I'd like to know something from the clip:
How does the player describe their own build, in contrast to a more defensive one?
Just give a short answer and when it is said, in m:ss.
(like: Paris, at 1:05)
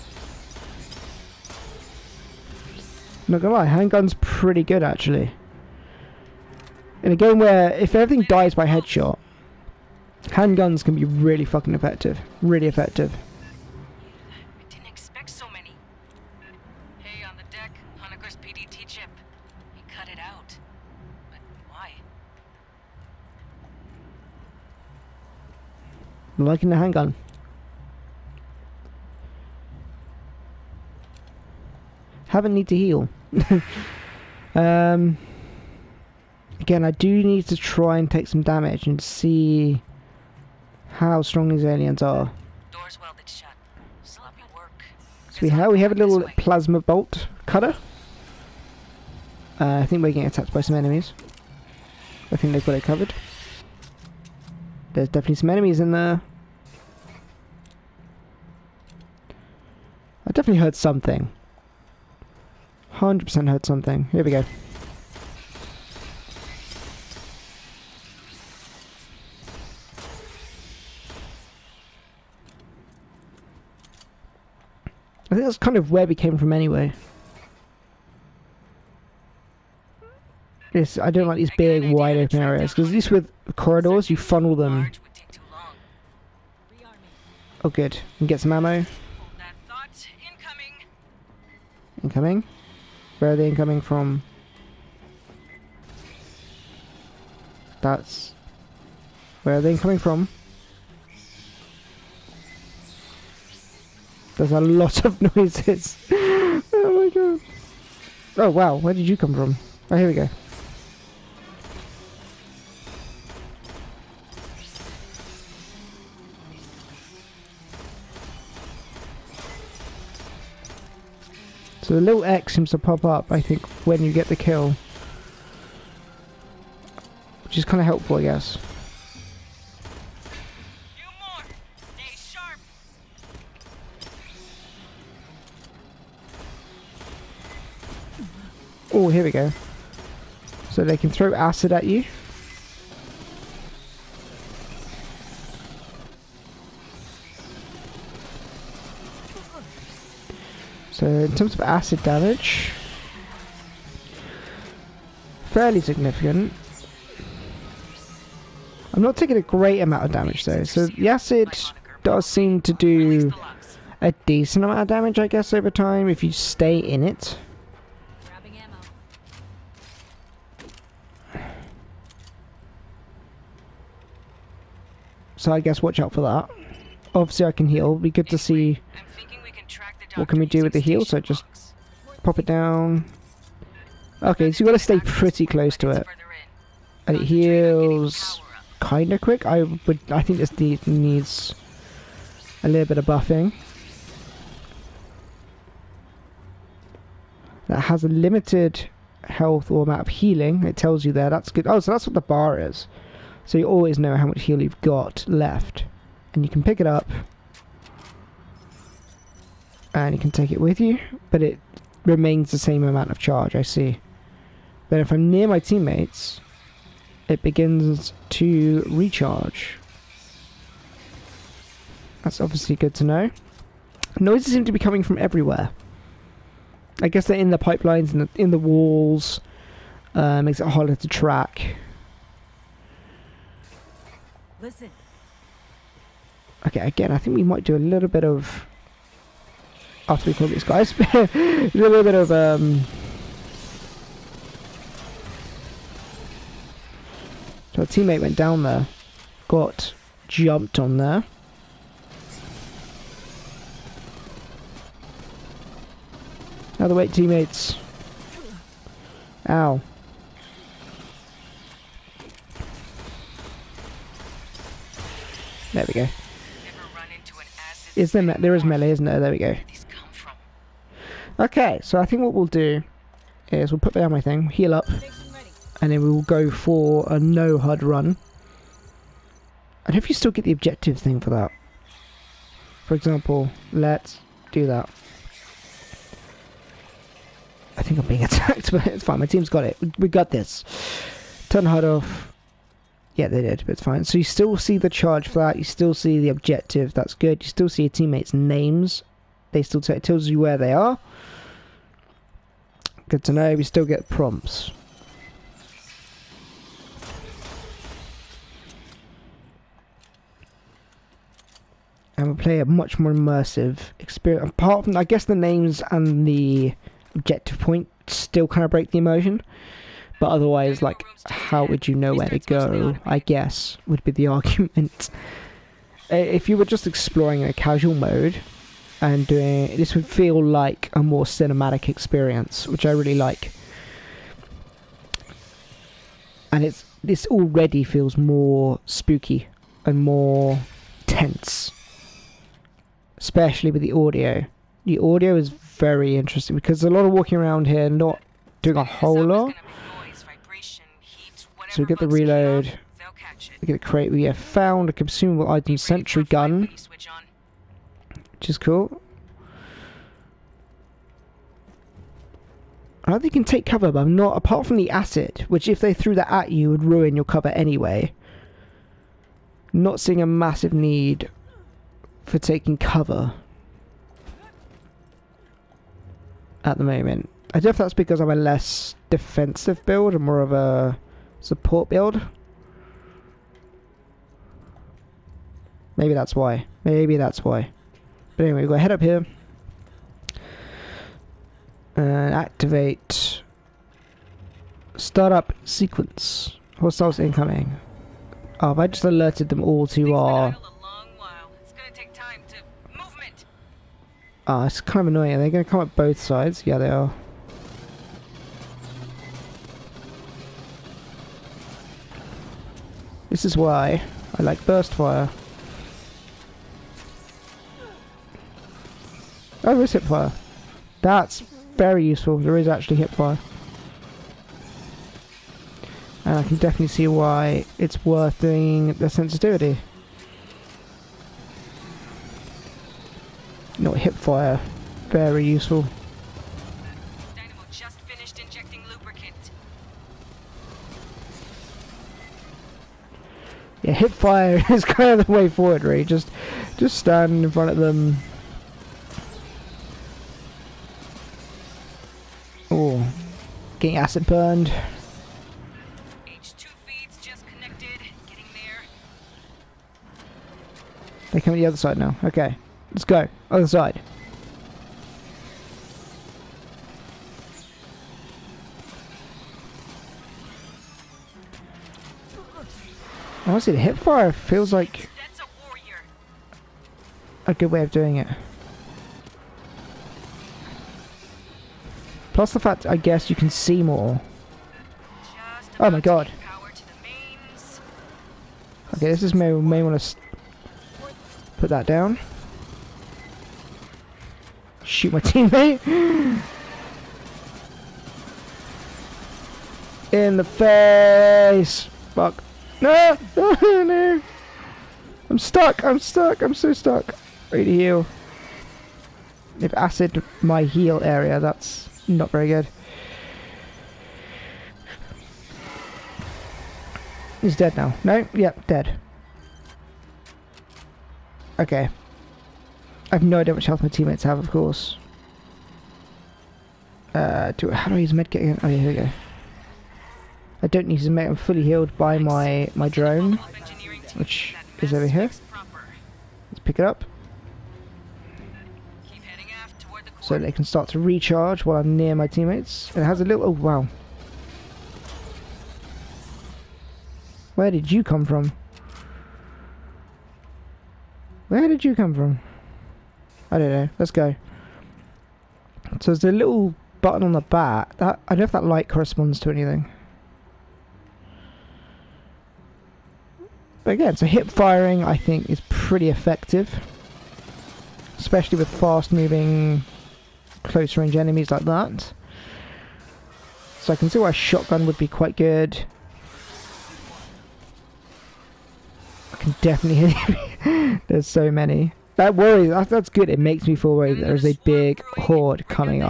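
Support build, at 6:21.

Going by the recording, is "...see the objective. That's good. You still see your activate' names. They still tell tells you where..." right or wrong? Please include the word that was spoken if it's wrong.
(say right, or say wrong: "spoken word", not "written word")
wrong: "teammates", not "activate".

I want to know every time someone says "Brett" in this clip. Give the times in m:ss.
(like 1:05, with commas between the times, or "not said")
not said.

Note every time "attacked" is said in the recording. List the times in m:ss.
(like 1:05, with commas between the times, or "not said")
0:50, 4:48.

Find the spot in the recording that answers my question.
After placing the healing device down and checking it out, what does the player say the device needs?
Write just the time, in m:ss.
3:13.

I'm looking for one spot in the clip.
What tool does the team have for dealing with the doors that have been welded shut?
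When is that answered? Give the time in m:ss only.
0:46.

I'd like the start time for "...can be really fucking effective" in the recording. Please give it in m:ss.
0:10.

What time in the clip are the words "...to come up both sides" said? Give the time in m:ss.
6:45.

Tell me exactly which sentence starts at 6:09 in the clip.
Not seeing a massive need for taking cover at the moment.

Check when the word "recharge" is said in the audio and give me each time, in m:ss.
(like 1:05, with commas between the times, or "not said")
3:38, 9:00.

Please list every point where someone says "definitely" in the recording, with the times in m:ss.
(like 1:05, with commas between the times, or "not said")
0:55, 1:00, 7:06, 9:39.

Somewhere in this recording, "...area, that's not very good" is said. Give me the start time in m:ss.
8:31.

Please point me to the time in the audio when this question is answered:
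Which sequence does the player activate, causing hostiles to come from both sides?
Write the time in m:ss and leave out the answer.
6:34.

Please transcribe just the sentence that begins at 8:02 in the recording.
Plus the fact, I guess, you can see more.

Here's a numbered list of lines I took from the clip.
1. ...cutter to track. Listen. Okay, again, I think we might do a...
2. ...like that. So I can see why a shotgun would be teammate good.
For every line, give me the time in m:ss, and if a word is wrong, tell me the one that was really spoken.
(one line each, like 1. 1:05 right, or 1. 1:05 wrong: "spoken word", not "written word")
1. 3:50 wrong: "harder", not "cutter"
2. 9:31 wrong: "quite", not "teammate".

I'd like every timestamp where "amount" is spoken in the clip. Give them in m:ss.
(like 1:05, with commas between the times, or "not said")
2:39, 2:44, 3:19, 3:32.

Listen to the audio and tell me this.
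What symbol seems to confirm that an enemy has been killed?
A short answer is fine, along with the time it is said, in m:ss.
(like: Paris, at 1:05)
X, at 2:02.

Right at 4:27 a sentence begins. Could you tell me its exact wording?
Is there, there is melee, isn't there?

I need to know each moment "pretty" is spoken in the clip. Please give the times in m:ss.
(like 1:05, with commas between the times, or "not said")
0:04, 3:05, 9:25.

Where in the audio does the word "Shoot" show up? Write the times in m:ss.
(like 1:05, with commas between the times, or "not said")
8:14.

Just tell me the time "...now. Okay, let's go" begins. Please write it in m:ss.
7:41.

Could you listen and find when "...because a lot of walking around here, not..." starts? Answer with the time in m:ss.
5:46.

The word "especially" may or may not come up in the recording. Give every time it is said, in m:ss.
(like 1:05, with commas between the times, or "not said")
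5:43, 9:28.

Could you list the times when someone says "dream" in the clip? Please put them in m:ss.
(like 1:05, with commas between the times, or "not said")
not said.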